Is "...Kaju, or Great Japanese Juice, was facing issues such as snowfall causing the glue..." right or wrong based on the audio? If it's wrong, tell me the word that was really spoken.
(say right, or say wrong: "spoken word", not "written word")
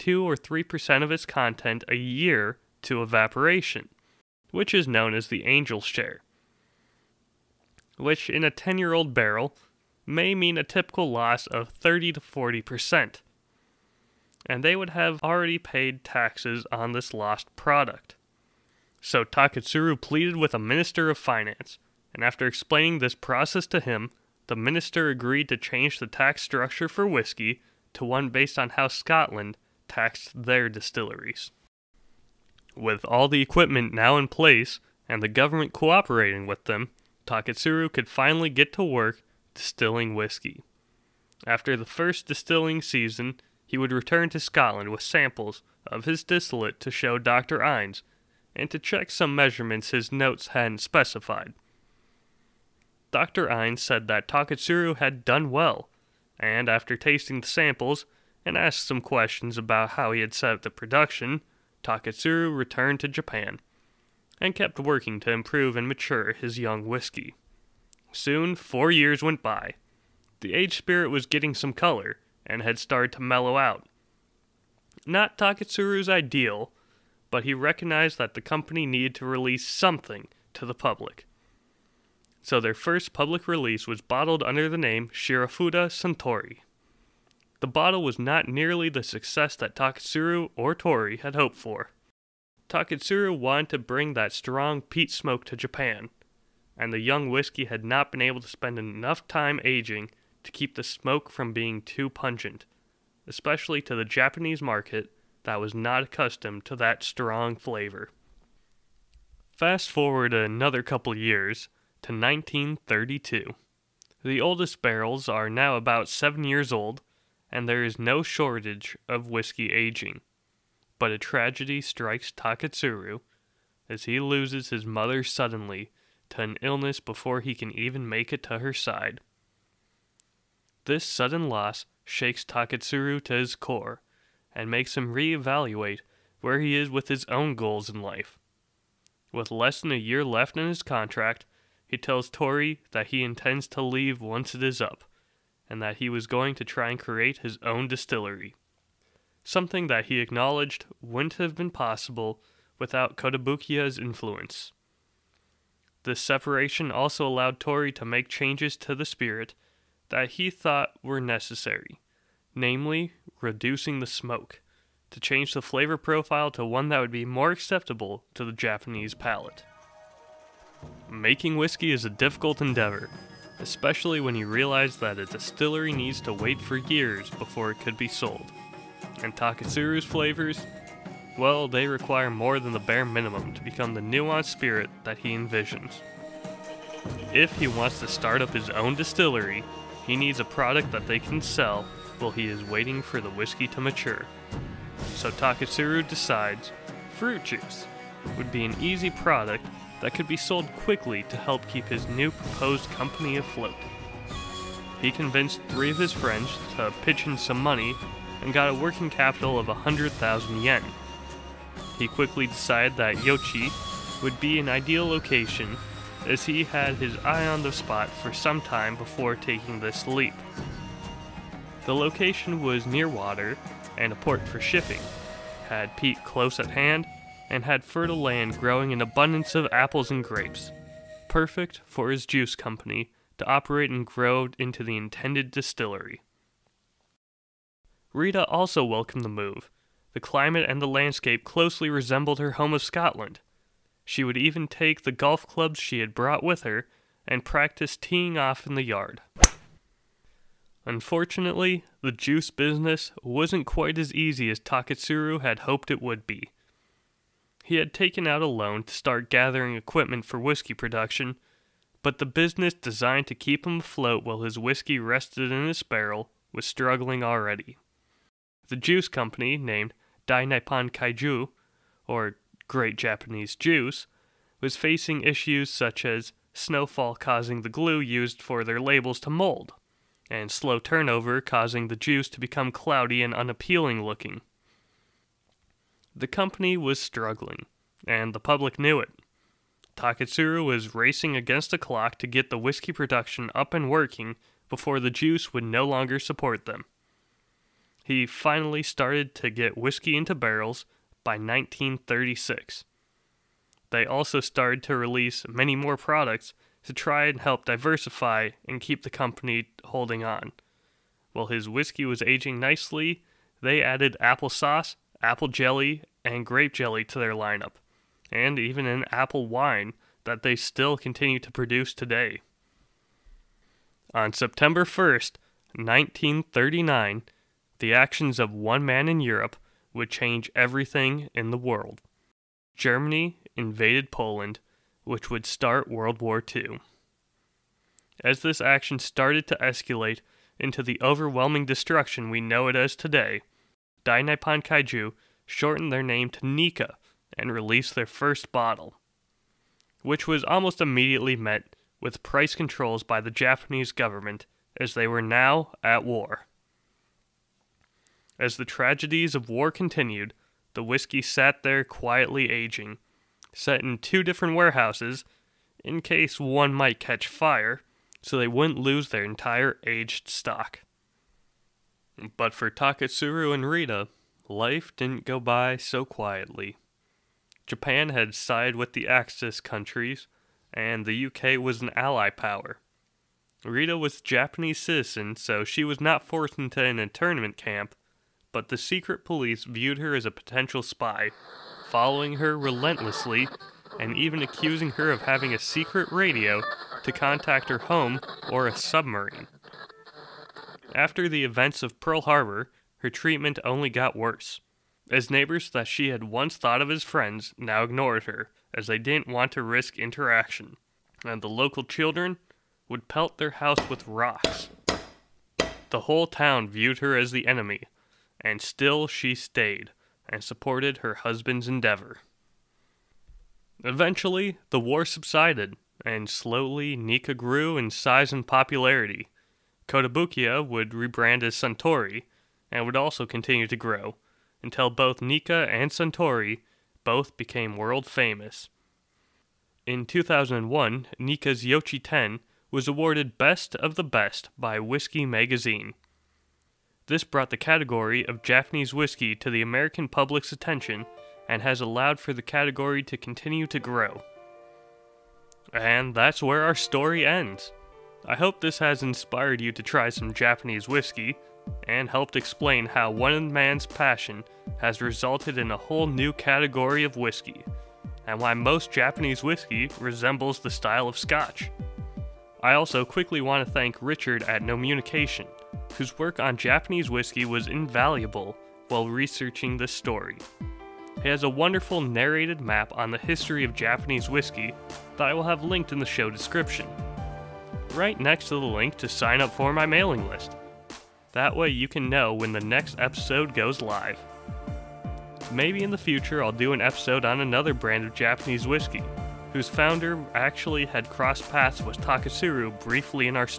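right.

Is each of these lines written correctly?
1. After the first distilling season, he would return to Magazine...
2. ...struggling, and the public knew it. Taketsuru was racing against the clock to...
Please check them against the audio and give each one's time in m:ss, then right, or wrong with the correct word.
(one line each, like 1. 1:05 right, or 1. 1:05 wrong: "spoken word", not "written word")
1. 0:41 wrong: "Scotland", not "Magazine"
2. 4:46 right.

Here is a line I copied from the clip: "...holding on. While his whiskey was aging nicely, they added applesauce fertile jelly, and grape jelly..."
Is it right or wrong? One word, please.
wrong.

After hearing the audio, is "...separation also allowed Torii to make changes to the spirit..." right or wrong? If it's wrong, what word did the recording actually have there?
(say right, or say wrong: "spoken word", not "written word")
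right.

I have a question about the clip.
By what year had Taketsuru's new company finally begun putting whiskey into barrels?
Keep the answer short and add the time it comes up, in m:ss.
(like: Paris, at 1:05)
1936, at 5:01.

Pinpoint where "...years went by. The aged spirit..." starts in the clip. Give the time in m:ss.
1:08.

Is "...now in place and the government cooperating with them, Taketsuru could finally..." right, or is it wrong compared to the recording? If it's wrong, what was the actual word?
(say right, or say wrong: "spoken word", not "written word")
right.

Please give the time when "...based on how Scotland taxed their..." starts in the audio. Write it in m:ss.
0:28.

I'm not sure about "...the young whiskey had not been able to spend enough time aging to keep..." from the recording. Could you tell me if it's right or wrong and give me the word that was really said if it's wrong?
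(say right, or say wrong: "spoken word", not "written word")
right.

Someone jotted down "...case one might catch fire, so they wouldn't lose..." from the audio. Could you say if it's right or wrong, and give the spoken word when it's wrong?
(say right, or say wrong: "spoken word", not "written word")
right.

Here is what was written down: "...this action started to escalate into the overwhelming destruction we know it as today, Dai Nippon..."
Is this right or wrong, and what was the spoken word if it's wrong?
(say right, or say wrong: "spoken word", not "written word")
right.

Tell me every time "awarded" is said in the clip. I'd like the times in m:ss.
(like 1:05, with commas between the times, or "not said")
7:22.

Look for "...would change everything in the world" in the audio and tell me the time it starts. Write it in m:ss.
5:29.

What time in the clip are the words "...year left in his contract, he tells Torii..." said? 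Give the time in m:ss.
2:19.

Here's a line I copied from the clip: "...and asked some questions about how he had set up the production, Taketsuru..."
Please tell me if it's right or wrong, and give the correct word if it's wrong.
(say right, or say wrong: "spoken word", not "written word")
right.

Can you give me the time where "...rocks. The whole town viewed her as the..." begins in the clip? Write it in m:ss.
6:54.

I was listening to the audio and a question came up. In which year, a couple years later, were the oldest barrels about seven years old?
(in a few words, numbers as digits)
1932.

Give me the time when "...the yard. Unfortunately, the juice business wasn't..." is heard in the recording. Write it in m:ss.
4:08.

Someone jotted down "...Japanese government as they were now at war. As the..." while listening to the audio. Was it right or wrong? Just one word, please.
right.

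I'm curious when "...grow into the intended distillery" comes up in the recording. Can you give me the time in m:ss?
3:54.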